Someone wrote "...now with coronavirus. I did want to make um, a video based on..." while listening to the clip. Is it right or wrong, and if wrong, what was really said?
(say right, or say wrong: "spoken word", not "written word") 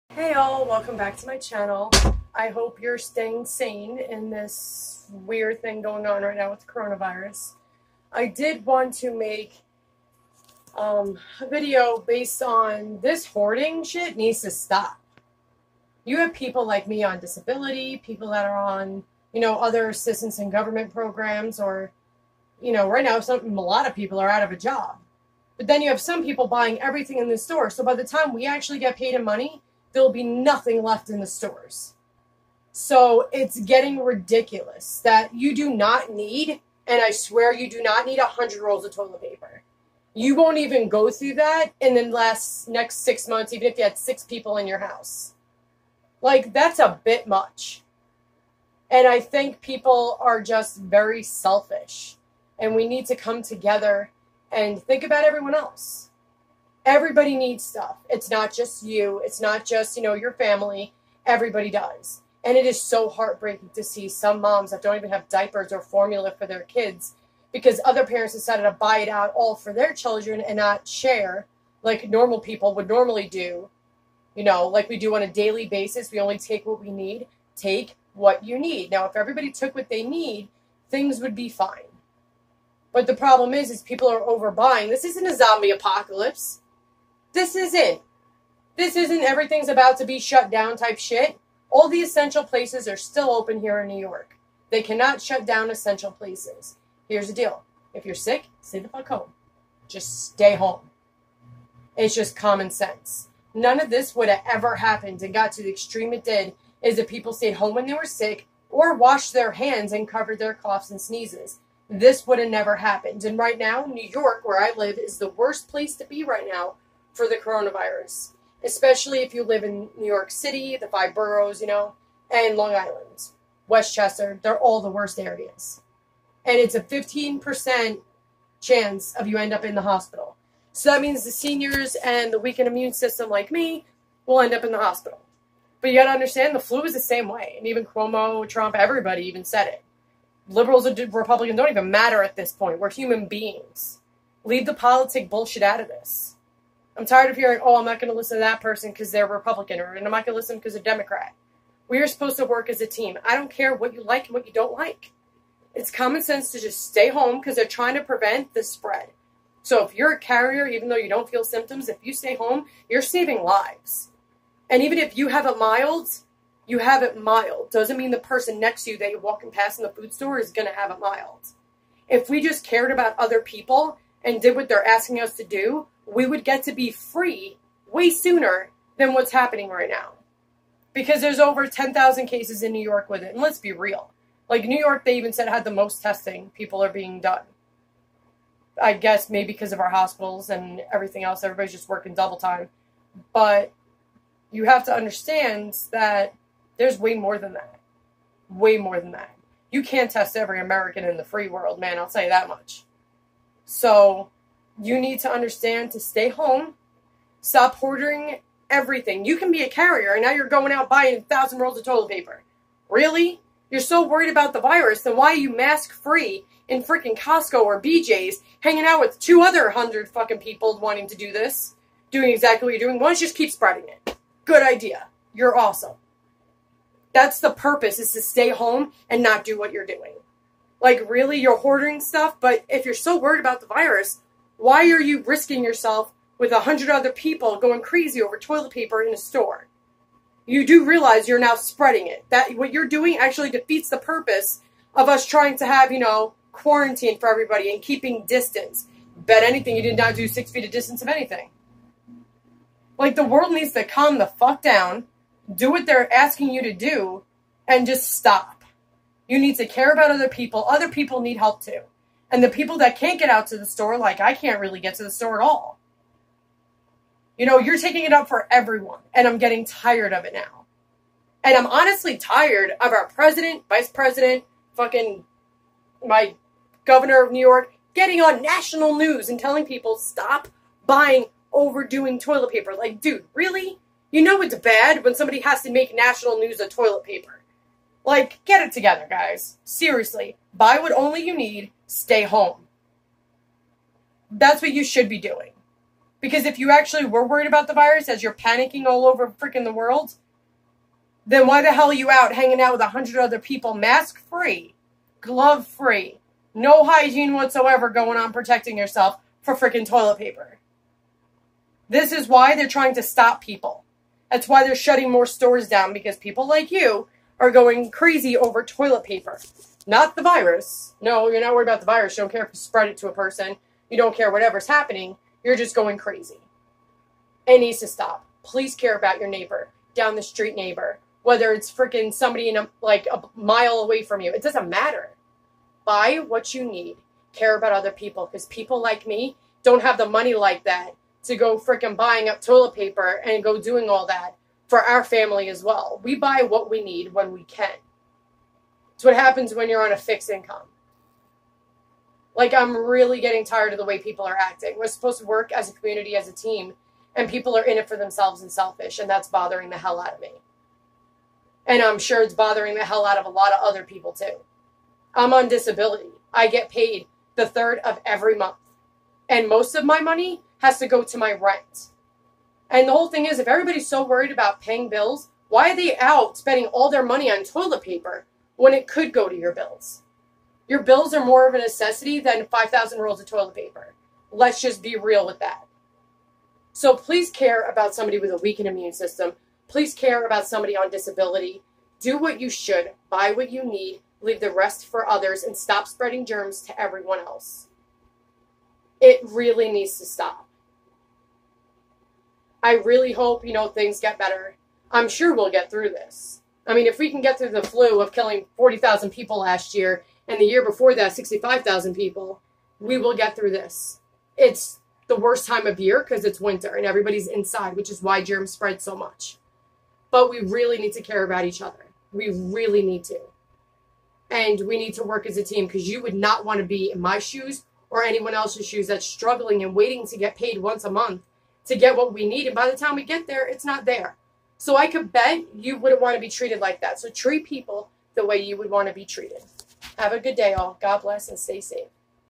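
right.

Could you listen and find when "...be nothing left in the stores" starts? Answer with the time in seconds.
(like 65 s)
30 s.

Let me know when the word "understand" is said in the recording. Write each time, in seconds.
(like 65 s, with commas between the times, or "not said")
136 s, 194 s, 205 s.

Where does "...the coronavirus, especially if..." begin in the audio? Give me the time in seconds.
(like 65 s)
117 s.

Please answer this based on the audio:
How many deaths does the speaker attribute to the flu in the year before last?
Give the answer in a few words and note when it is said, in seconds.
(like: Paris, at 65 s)
65,000, at 411 s.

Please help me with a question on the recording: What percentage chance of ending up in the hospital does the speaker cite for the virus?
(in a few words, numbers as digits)
15%.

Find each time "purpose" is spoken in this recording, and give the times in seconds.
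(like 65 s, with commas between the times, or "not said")
227 s, 243 s.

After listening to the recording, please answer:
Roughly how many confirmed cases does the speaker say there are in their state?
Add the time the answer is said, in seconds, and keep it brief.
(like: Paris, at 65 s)
over 10,000, at 181 s.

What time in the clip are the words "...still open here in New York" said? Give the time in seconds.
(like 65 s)
92 s.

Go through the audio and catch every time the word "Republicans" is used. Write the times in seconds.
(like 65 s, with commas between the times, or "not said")
141 s, 149 s.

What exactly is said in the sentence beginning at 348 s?
It's what happens when you're on a fixed income.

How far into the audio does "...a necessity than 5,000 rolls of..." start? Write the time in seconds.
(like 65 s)
381 s.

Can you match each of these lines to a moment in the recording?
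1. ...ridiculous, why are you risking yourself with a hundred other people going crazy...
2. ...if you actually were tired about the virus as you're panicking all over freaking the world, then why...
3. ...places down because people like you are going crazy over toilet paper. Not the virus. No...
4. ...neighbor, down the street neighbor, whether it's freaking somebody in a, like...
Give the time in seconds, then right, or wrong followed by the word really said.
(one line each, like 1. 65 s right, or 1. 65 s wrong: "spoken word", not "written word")
1. 233 s wrong: "virus", not "ridiculous"
2. 296 s wrong: "worried", not "tired"
3. 315 s wrong: "stores", not "places"
4. 329 s right.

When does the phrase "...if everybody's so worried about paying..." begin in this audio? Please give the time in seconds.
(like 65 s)
373 s.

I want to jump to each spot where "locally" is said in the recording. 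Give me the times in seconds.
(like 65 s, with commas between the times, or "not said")
not said.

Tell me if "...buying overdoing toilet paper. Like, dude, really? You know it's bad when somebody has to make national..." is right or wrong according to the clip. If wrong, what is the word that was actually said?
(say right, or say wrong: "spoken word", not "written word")
right.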